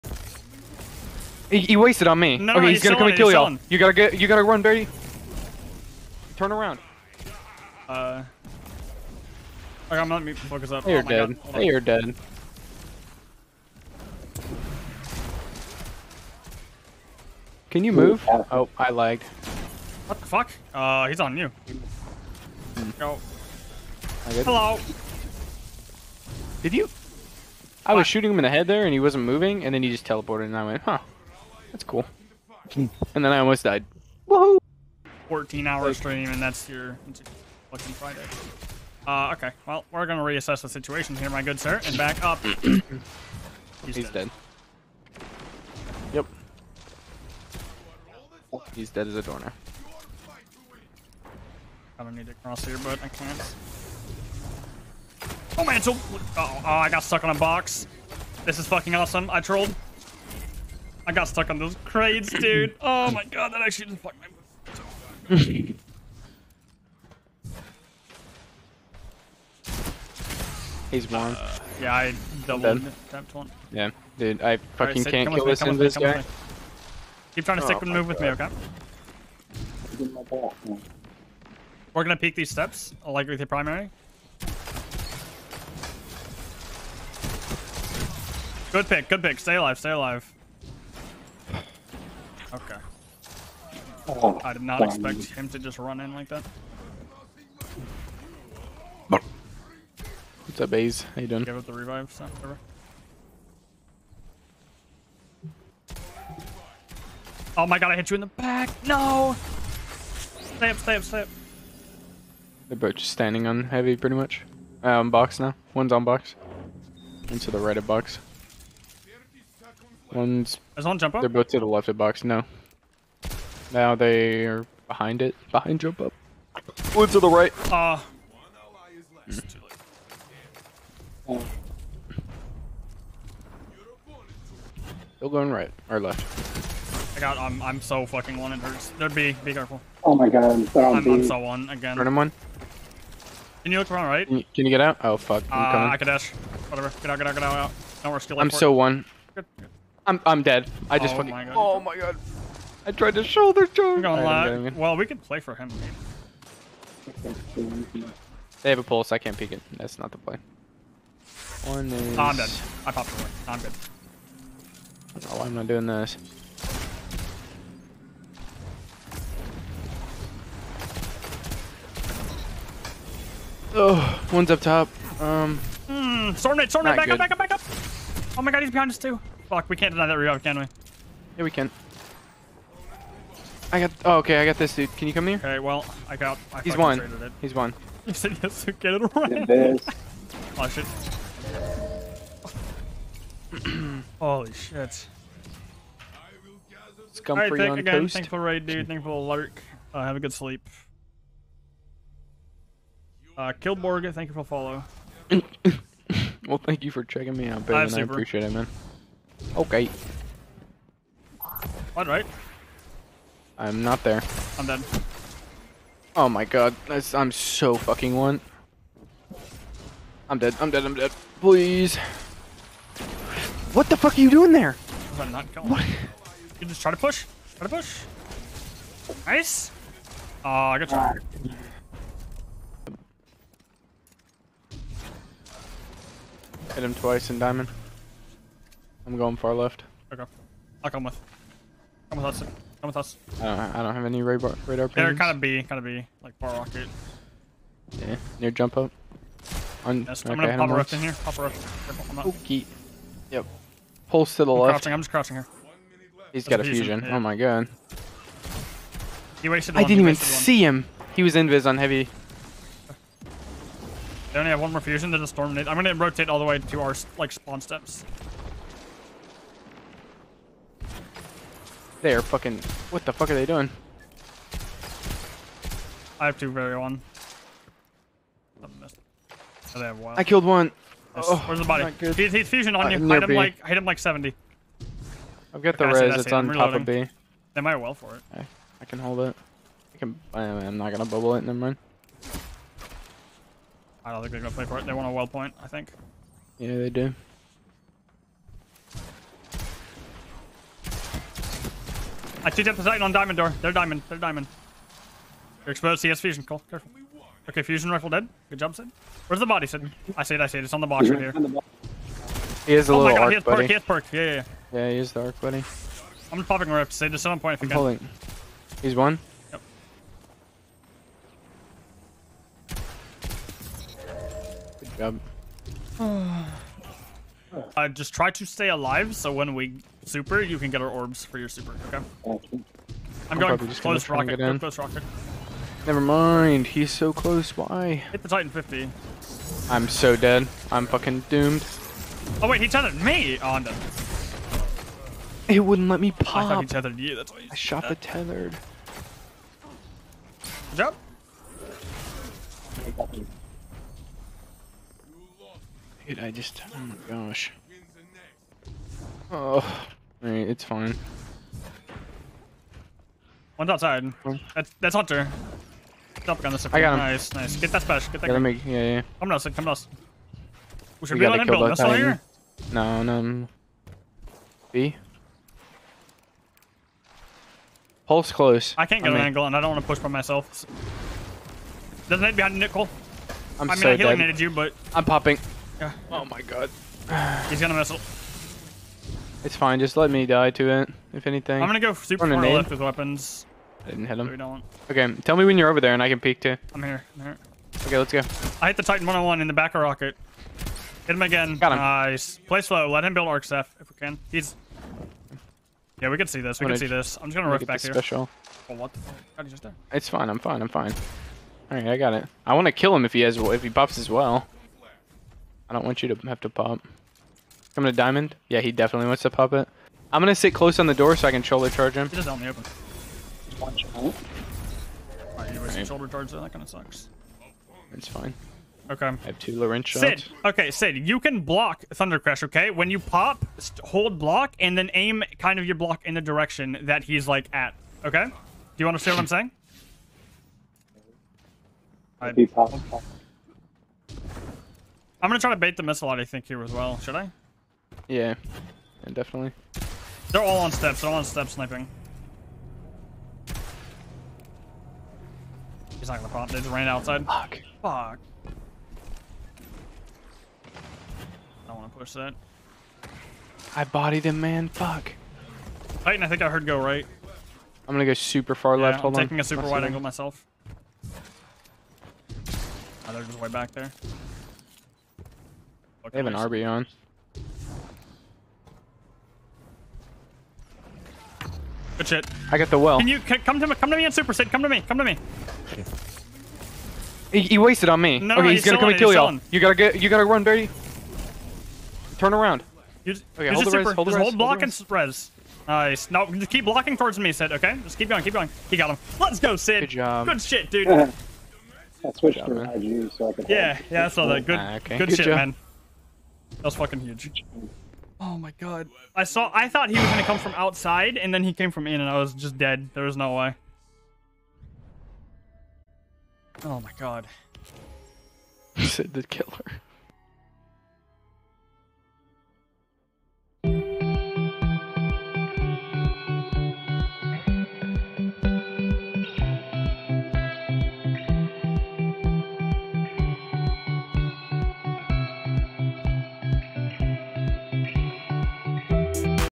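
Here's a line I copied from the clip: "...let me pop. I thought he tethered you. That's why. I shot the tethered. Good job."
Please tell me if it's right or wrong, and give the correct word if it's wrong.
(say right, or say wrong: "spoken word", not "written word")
right.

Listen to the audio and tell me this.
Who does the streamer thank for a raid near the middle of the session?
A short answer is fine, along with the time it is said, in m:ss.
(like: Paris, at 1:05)
Scumfree, at 3:17.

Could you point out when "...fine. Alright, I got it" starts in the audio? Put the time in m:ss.
6:50.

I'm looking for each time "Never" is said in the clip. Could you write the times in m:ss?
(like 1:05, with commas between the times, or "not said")
4:51, 5:35.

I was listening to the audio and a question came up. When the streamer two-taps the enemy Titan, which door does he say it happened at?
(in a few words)
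diamond door.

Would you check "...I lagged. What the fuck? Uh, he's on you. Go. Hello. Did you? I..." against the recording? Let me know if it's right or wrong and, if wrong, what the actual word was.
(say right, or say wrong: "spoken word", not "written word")
right.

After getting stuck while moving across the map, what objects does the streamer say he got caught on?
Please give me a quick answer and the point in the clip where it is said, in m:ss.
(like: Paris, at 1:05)
crates, at 1:01.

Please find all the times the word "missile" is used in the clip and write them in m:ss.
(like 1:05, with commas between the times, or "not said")
6:27, 7:25.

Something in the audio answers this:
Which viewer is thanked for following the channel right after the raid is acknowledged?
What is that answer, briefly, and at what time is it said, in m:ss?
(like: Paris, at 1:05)
Killborg, at 3:23.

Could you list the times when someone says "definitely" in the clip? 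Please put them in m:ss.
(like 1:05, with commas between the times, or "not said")
6:58, 7:29.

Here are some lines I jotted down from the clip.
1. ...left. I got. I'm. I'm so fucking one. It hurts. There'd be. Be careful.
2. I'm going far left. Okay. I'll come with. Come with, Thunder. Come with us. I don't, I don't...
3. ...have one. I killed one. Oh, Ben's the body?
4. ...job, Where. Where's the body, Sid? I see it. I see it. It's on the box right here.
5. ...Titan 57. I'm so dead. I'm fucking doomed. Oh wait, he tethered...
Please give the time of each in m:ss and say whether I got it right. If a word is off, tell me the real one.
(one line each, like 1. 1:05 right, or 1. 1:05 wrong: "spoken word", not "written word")
1. 2:16 right
2. 3:59 wrong: "Hudson", not "Thunder"
3. 4:39 wrong: "Where", not "Ben"
4. 5:08 wrong: "Sid", not "Where"
5. 5:38 wrong: "50", not "57".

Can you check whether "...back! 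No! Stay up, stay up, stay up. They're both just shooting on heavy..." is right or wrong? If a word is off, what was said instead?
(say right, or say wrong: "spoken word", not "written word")
wrong: "standing", not "shooting".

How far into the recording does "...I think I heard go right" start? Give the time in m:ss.
7:46.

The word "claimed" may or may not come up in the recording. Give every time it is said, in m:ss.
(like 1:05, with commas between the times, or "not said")
not said.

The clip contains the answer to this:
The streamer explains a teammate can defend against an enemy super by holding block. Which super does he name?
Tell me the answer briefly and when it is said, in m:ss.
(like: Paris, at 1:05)
Thunder Crash, at 7:11.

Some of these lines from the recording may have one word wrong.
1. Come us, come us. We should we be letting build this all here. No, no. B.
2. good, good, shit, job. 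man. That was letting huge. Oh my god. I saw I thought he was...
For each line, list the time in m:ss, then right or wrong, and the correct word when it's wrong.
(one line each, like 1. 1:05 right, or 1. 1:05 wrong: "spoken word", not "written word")
1. 6:09 right
2. 8:24 wrong: "fucking", not "letting".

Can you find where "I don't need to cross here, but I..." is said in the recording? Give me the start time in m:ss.
0:51.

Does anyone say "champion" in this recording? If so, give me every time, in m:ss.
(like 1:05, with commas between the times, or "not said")
not said.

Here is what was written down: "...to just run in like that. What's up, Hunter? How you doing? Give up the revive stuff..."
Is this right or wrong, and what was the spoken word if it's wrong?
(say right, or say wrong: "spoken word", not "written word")
wrong: "Baze", not "Hunter".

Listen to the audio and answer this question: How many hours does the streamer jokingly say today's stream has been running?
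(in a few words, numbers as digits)
14.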